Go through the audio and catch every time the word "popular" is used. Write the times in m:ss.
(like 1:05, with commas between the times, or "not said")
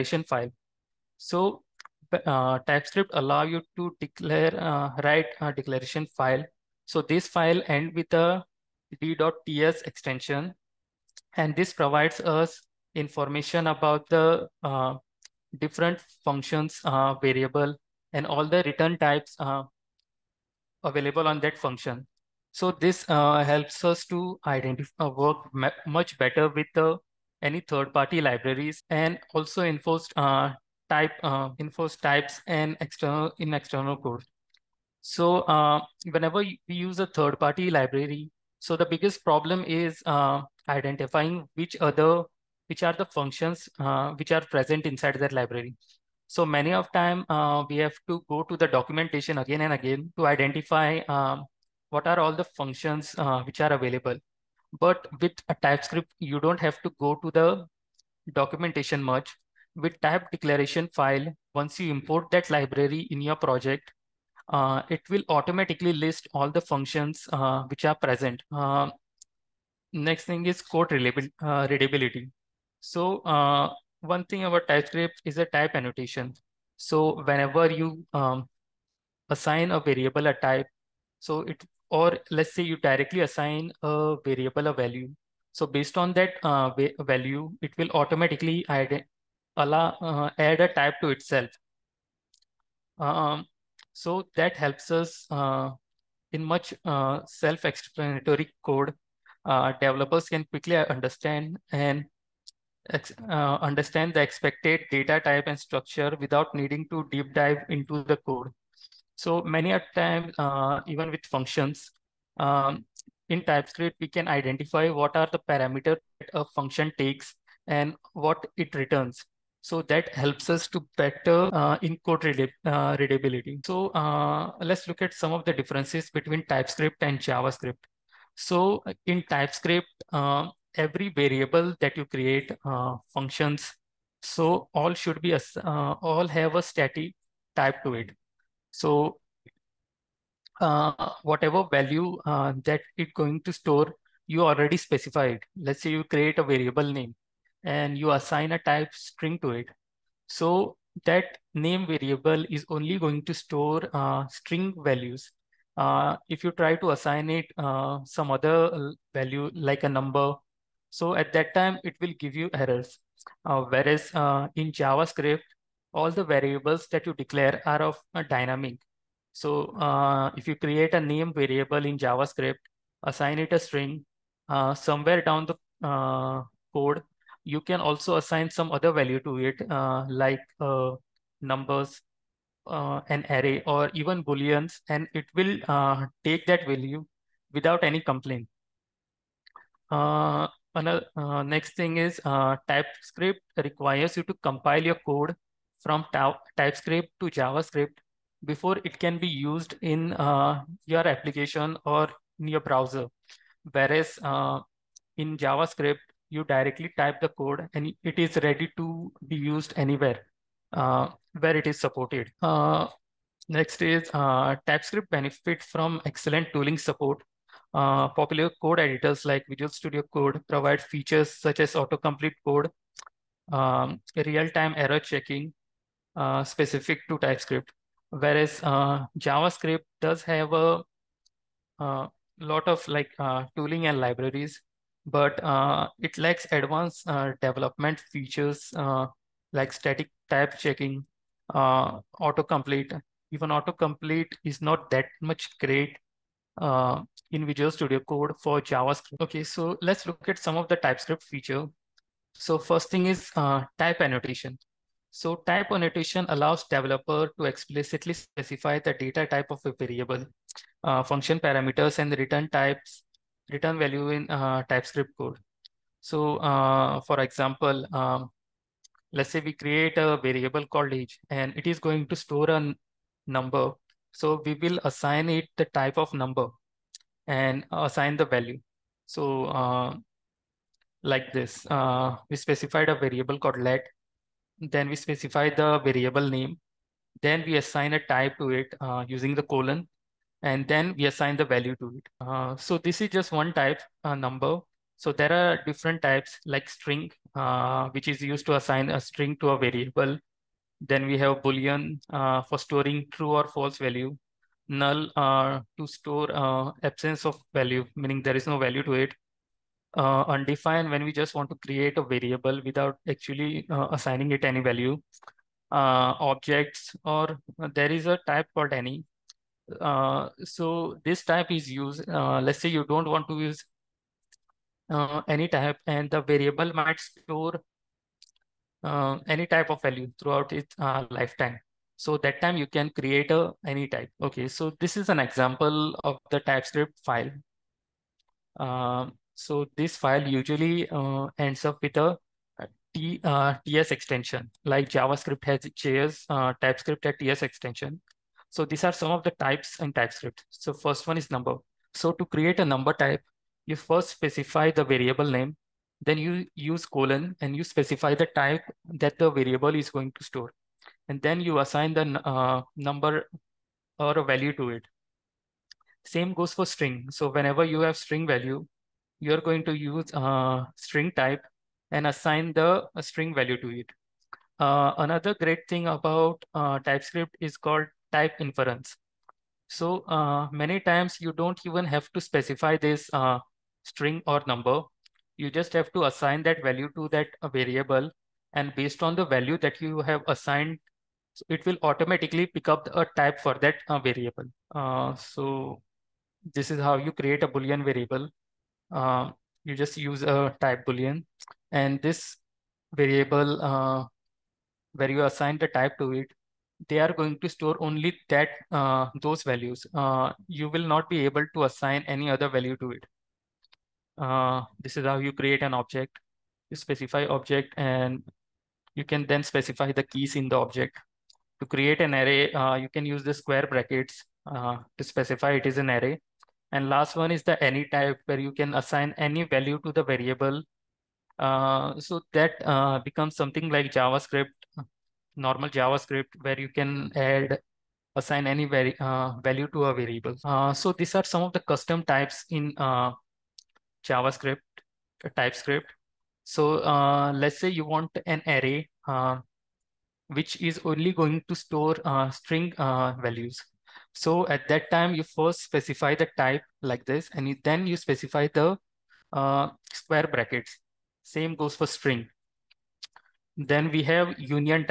3:38.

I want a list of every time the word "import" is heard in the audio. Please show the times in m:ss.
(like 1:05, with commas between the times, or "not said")
1:01.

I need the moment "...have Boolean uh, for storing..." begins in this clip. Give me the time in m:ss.
5:01.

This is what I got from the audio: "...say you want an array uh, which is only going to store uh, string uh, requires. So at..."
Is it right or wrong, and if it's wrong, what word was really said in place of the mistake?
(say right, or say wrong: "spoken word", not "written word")
wrong: "values", not "requires".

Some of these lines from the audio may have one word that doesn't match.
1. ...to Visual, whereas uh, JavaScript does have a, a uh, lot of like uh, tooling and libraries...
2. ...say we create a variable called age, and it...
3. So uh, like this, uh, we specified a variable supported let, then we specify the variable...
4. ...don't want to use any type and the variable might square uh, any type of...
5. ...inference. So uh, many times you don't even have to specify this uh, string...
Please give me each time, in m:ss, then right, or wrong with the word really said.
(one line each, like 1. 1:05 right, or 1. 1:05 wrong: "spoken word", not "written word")
1. 3:47 wrong: "TypeScript", not "Visual"
2. 4:29 right
3. 4:39 wrong: "called", not "supported"
4. 5:22 wrong: "store", not "square"
5. 6:18 right.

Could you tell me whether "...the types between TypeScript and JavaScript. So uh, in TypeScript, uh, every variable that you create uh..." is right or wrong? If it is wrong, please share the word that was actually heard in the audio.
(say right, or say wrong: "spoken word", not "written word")
wrong: "differences", not "types".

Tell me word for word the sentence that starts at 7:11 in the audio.
Uh, so that uh, becomes something like JavaScript, normal JavaScript, where you can add assign any uh, value to a variable.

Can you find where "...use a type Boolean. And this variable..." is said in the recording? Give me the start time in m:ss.
6:39.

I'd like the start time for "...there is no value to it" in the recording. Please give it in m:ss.
5:08.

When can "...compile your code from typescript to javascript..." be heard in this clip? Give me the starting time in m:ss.
3:14.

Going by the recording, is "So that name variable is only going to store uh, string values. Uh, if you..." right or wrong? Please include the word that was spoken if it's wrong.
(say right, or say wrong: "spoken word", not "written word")
right.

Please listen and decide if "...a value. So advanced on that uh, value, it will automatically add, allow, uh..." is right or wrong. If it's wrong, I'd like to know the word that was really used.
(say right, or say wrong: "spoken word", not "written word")
wrong: "based", not "advanced".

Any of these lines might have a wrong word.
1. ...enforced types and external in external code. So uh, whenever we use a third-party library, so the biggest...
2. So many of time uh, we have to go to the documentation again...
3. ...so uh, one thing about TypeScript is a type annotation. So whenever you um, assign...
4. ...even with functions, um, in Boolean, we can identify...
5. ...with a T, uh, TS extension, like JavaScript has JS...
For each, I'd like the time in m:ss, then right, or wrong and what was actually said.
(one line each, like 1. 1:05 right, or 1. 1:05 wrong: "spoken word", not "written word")
1. 0:31 right
2. 0:46 right
3. 1:12 right
4. 1:50 wrong: "TypeScript", not "Boolean"
5. 5:41 right.